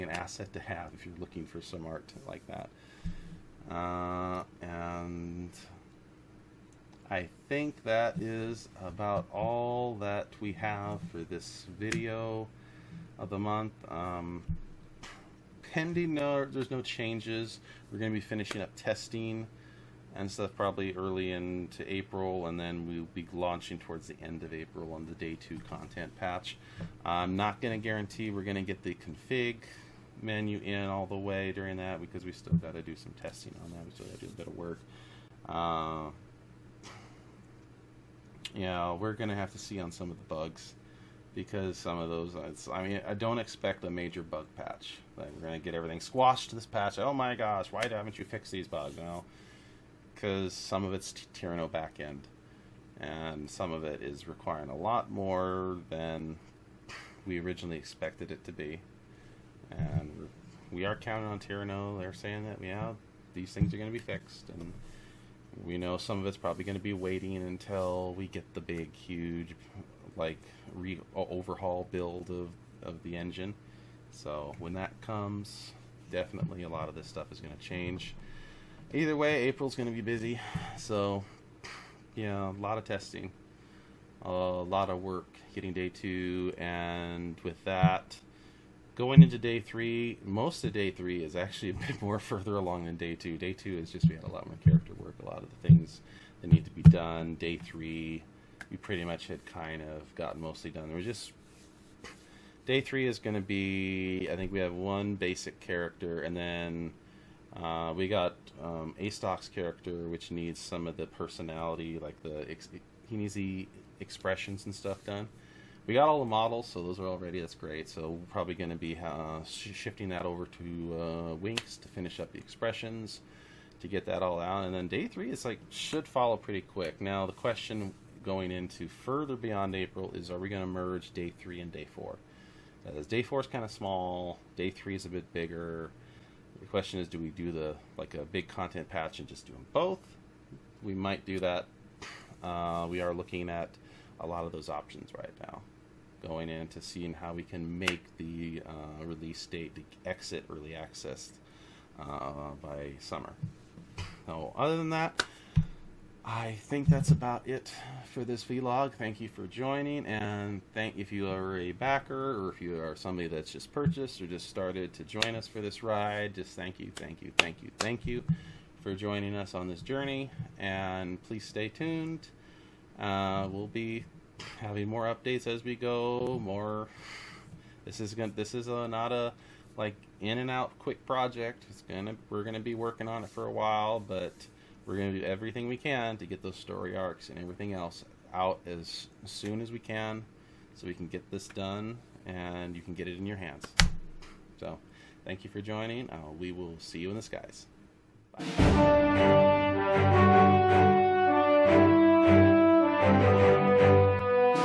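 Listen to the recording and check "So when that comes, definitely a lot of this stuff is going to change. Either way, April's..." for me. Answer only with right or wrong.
right.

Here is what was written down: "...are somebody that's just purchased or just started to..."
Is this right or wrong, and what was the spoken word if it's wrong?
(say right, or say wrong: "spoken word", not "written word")
right.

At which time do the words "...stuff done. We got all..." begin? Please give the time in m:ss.
1:54.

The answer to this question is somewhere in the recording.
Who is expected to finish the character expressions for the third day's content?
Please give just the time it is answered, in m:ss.
2:01.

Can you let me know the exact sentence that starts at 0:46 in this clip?
Oh my gosh, why haven't you fixed these bugs?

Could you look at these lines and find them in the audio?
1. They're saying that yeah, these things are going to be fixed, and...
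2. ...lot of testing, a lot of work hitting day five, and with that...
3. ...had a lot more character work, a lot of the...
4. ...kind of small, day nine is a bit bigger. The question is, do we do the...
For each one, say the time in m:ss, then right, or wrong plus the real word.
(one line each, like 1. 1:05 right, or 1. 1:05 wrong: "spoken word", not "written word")
1. 1:01 right
2. 1:22 wrong: "two", not "five"
3. 1:34 right
4. 2:13 wrong: "three", not "nine".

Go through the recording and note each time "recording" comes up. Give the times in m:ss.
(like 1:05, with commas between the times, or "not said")
not said.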